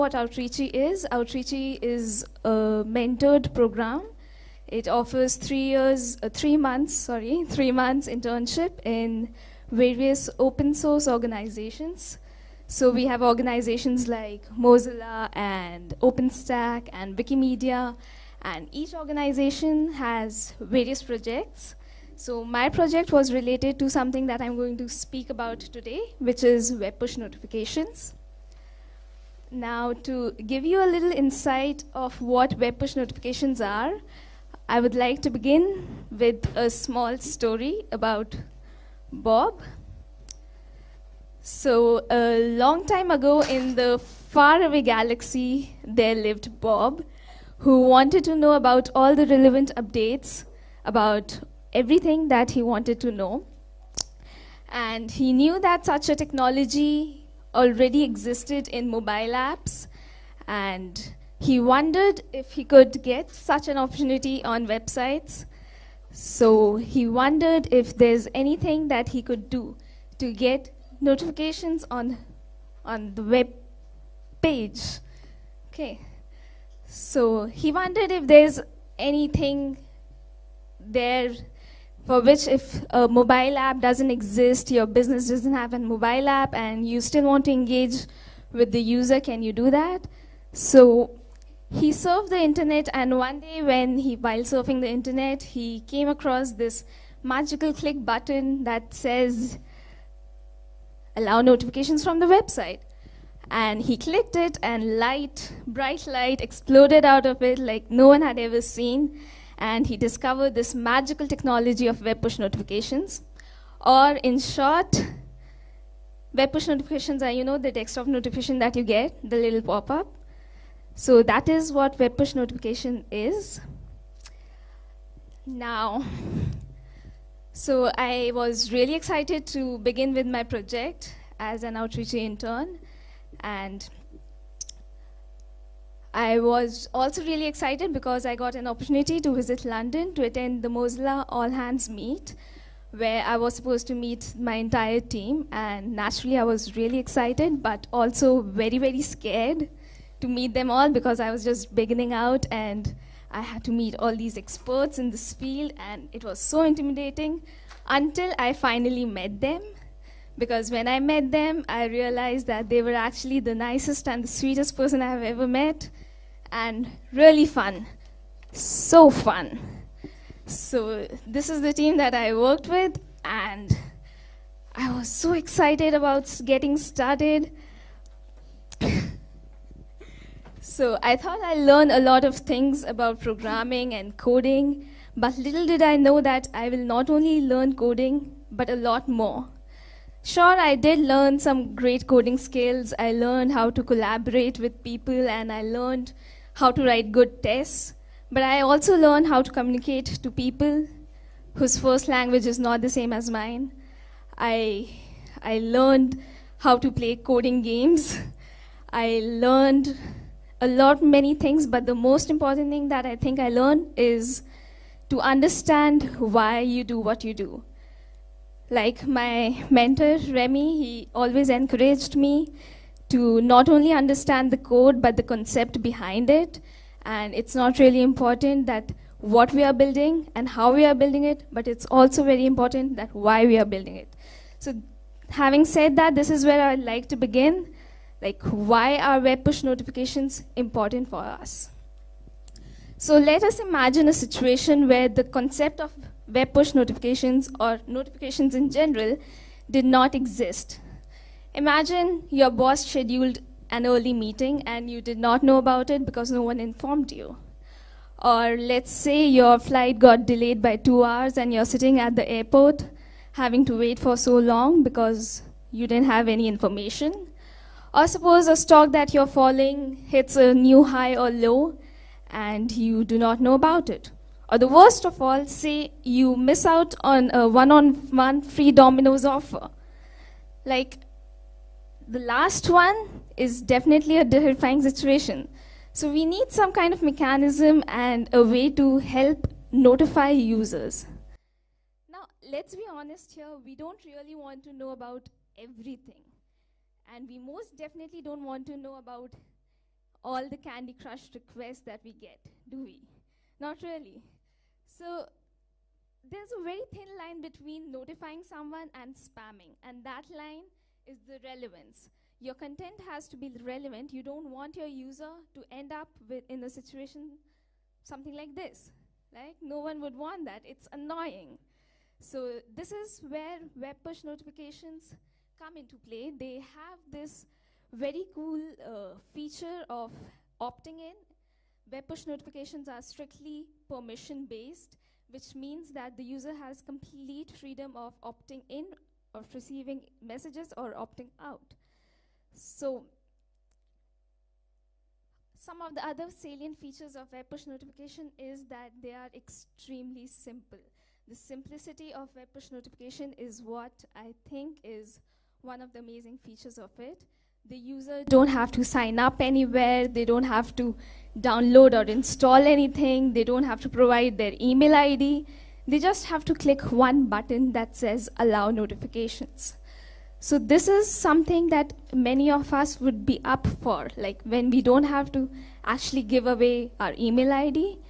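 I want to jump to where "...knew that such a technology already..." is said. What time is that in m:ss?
0:55.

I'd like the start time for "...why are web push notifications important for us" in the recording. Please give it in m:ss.
3:58.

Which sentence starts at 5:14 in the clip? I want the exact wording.
You don't want your user to end up with, in a situation something like this.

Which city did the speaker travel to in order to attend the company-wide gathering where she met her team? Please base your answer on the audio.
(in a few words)
London.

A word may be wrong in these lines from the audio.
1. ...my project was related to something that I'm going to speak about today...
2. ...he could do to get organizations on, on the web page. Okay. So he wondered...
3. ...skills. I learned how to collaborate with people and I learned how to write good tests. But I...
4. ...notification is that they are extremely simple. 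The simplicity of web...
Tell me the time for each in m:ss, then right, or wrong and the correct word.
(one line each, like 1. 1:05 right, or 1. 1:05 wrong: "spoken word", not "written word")
1. 0:22 right
2. 1:09 wrong: "notifications", not "organizations"
3. 3:12 right
4. 5:47 right.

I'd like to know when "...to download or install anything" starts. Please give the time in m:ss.
6:00.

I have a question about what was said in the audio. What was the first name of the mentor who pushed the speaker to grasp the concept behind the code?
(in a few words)
Remy.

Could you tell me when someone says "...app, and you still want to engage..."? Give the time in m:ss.
1:26.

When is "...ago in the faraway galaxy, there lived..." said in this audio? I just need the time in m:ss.
0:43.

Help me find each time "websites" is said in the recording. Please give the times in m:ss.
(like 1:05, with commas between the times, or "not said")
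1:04, 1:42.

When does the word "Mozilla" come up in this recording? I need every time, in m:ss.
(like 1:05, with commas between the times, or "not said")
0:14, 2:20.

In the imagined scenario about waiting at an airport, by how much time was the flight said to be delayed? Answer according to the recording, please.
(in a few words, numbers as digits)
2 hours.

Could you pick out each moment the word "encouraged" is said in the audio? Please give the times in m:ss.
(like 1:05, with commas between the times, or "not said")
3:41.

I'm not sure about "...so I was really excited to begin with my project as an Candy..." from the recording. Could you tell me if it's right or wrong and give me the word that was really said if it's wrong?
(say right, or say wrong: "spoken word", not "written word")
wrong: "Outreachy", not "Candy".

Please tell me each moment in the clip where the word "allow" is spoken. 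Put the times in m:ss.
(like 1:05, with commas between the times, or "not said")
1:41, 6:08.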